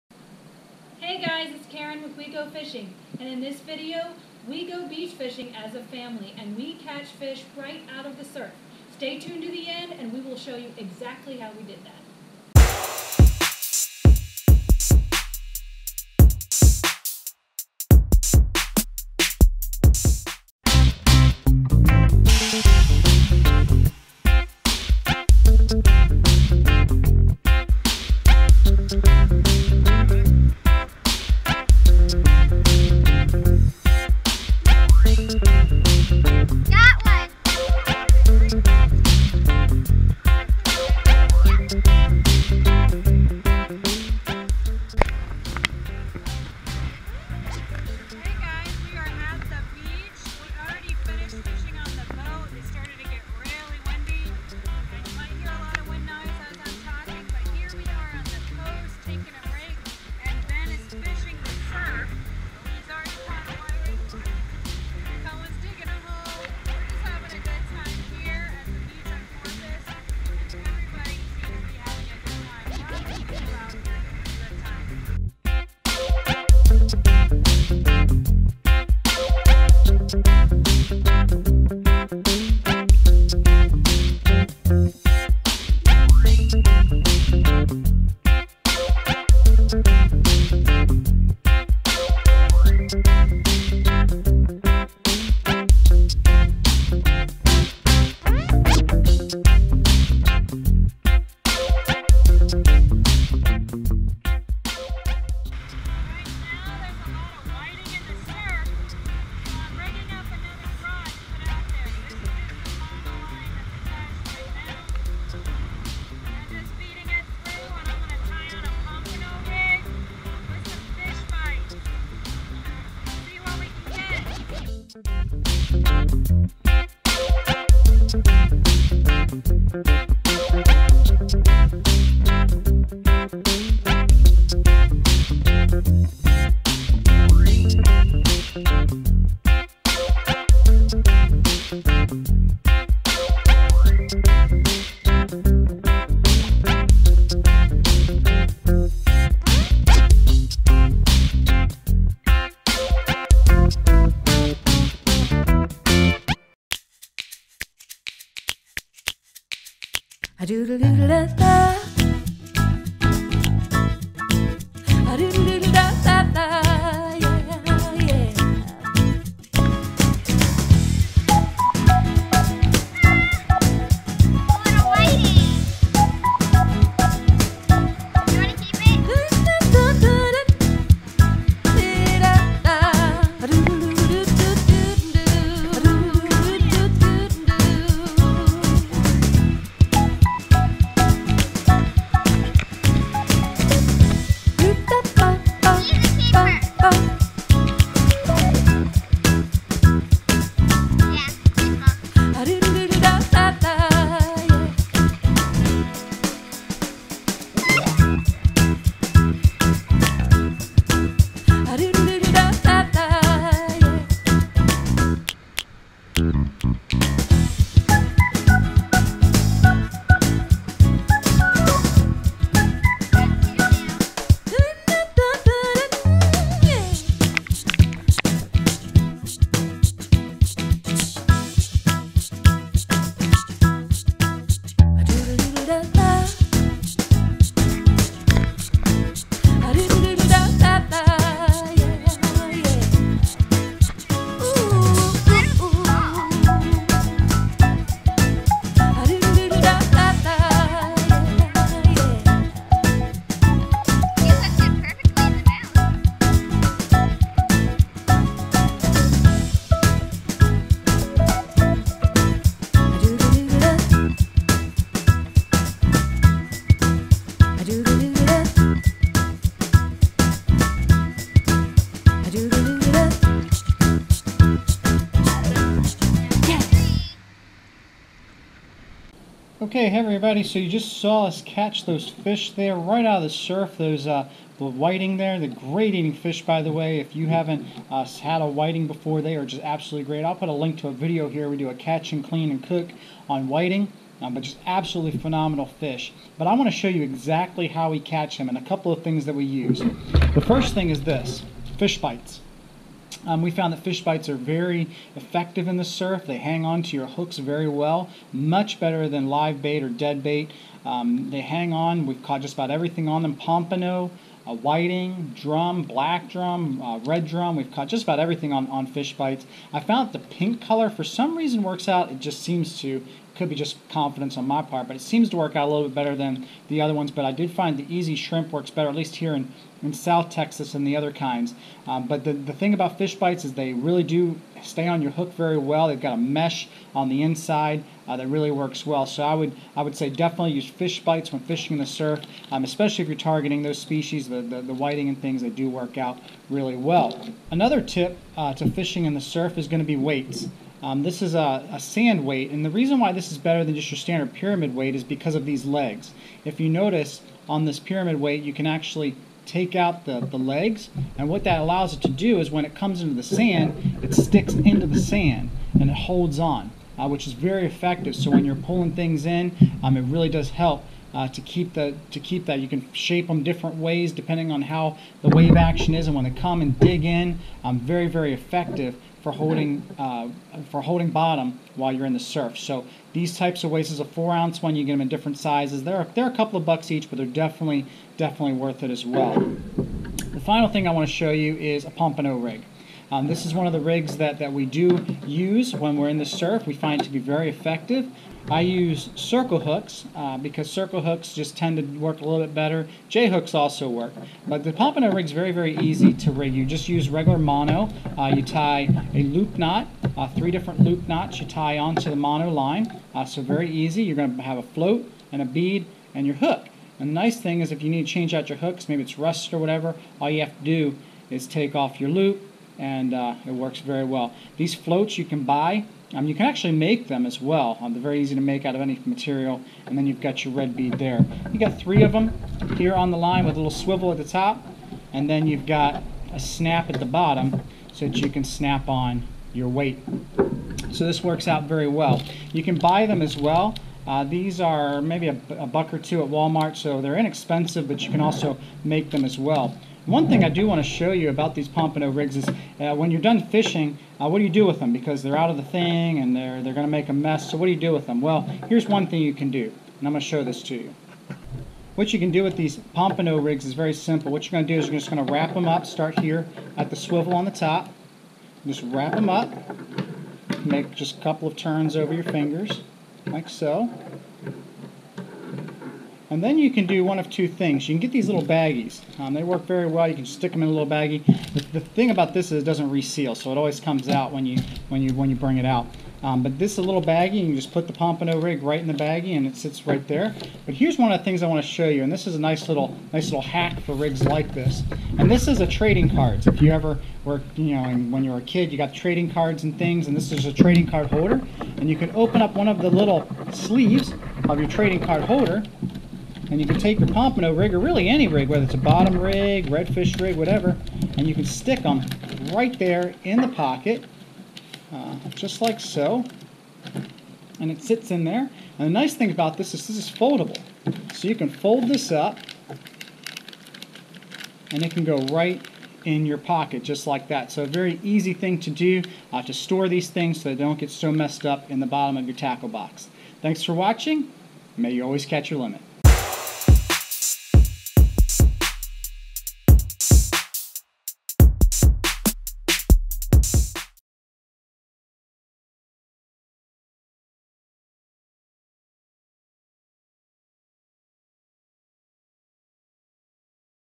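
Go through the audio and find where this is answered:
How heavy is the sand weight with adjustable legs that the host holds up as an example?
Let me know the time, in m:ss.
6:24.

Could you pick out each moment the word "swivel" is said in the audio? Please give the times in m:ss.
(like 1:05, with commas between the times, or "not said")
7:13, 7:46.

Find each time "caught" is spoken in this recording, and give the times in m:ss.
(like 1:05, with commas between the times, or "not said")
5:12, 5:17.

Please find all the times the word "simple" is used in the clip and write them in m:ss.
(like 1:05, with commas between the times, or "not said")
7:43.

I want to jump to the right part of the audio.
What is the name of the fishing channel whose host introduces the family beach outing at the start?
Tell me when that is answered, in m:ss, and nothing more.
0:02.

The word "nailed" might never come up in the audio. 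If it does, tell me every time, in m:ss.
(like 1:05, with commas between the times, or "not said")
not said.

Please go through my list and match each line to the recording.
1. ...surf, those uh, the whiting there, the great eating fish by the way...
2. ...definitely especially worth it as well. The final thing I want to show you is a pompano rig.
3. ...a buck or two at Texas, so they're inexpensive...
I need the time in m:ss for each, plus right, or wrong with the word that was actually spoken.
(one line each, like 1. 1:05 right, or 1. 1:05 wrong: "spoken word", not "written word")
1. 4:43 right
2. 6:27 wrong: "definitely", not "especially"
3. 7:25 wrong: "Walmart", not "Texas".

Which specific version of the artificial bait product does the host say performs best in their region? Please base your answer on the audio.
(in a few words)
E-Z Shrimp.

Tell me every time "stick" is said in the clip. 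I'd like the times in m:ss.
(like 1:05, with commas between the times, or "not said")
6:04, 8:00, 8:31.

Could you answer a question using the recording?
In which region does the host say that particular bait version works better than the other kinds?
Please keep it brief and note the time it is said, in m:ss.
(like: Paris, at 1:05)
South Texas, at 5:29.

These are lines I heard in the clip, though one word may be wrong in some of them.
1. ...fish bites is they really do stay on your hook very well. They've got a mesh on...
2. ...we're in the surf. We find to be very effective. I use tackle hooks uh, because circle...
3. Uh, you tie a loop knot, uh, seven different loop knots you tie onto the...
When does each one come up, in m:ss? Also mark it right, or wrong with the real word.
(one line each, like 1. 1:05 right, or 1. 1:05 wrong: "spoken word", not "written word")
1. 5:32 right
2. 6:35 wrong: "circle", not "tackle"
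3. 6:48 wrong: "three", not "seven".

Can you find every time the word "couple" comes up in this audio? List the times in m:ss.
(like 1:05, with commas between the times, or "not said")
4:58, 6:26, 7:51.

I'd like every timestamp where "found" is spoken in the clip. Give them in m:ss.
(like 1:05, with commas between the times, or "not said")
5:03, 5:19.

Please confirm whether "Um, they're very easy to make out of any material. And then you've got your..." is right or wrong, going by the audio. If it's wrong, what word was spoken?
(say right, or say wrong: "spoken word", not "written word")
right.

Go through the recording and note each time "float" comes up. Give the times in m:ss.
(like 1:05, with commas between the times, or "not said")
6:54, 7:04.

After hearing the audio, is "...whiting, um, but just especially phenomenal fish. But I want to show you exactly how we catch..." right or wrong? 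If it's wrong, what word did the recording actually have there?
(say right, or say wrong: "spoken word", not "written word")
wrong: "absolutely", not "especially".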